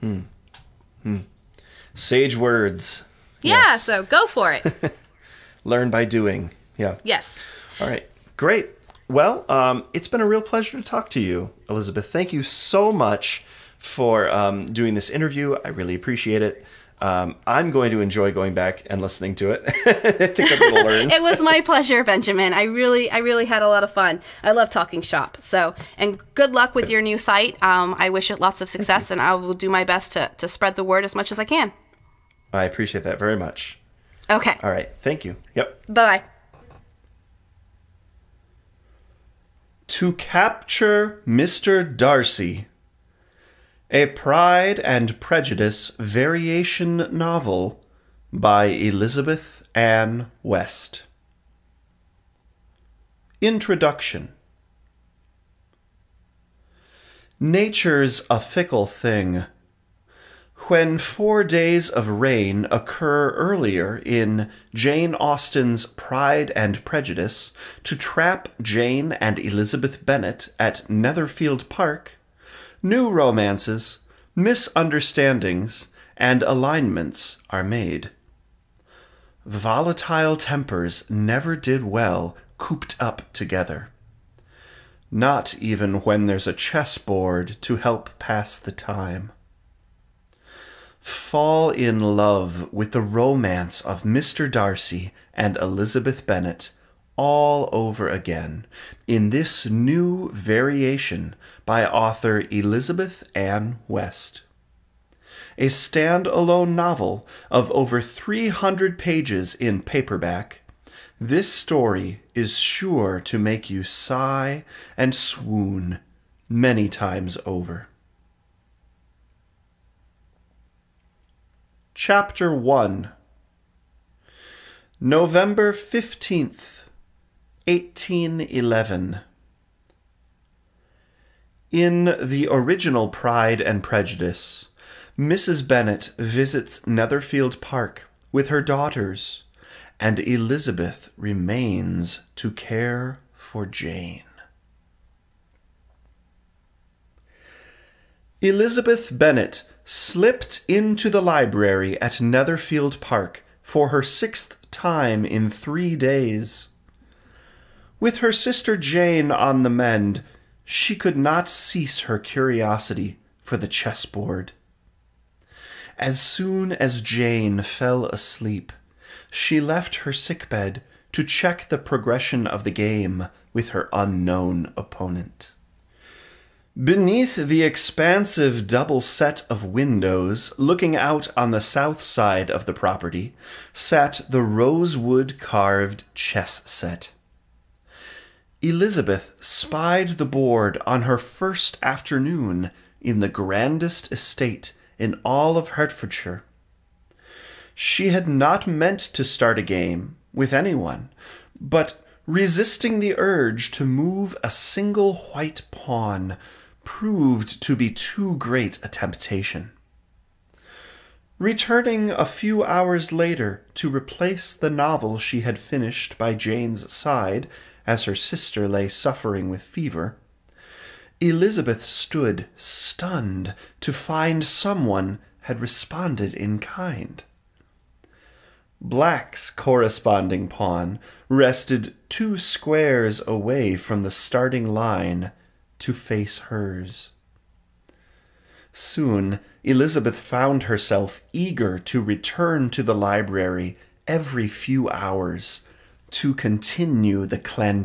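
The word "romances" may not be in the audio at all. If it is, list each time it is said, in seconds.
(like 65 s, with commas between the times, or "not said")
73 s, 93 s.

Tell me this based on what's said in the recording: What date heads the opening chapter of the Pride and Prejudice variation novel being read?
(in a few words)
November 15th, 1811.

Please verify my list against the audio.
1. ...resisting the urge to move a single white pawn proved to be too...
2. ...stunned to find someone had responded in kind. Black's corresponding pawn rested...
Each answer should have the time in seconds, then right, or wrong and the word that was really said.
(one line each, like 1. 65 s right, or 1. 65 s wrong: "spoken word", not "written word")
1. 202 s right
2. 222 s right.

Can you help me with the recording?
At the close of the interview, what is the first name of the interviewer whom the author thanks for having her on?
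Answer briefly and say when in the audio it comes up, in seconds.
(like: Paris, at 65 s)
Benjamin, at 22 s.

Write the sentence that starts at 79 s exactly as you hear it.
Volatile tempers never did well cooped up together.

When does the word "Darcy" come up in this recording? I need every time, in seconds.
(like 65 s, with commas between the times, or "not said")
41 s, 94 s.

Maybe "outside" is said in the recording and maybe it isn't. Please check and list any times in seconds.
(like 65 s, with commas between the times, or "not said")
not said.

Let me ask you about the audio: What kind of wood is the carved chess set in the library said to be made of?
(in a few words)
Rosewood.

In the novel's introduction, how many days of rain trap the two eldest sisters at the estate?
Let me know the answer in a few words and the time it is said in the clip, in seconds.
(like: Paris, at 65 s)
4, at 60 s.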